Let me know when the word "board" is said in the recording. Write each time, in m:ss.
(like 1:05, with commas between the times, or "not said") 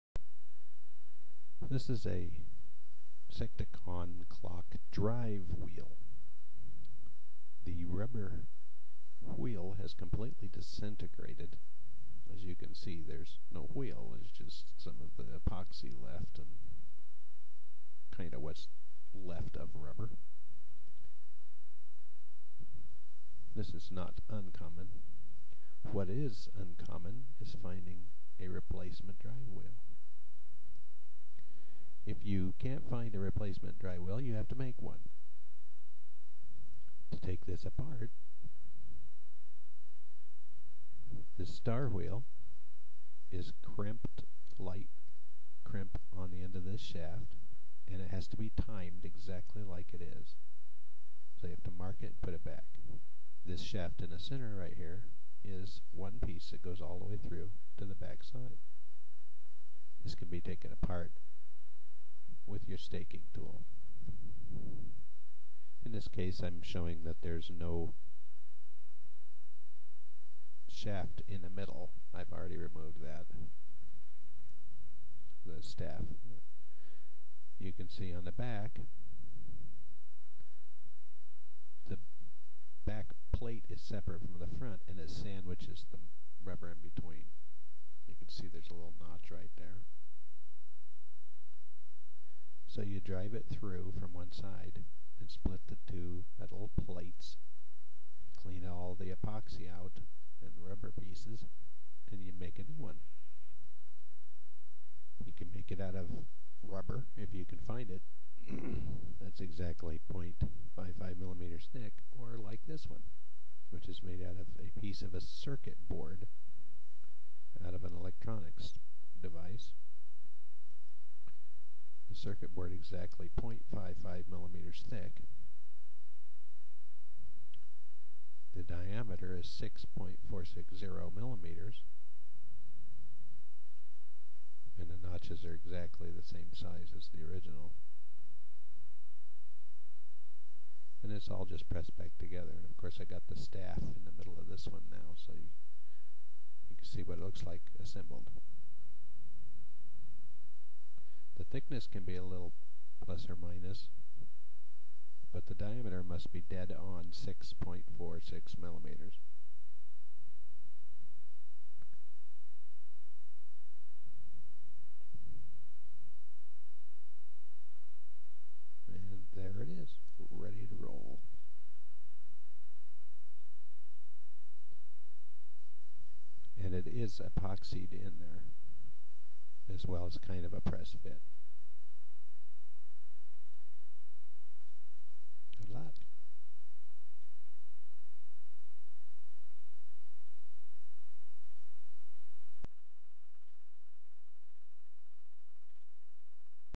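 1:55, 2:02.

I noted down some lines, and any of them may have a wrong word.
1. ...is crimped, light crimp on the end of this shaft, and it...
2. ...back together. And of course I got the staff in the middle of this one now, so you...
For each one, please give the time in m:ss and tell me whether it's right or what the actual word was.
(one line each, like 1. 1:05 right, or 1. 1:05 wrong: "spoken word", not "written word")
1. 0:43 right
2. 2:21 right.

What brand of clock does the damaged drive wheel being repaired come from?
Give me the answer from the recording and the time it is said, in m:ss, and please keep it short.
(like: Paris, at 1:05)
Secticon, at 0:03.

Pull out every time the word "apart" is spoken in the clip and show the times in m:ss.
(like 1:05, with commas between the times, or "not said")
0:37, 1:00.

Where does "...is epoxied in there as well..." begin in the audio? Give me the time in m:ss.
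2:56.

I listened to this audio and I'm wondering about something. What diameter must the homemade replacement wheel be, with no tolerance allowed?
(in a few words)
6.460 millimeters.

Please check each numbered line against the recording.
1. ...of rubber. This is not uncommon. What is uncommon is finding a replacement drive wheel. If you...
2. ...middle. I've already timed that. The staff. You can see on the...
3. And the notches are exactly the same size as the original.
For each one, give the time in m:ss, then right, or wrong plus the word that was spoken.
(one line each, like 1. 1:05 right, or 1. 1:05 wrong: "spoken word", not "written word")
1. 0:19 right
2. 1:11 wrong: "removed", not "timed"
3. 2:14 right.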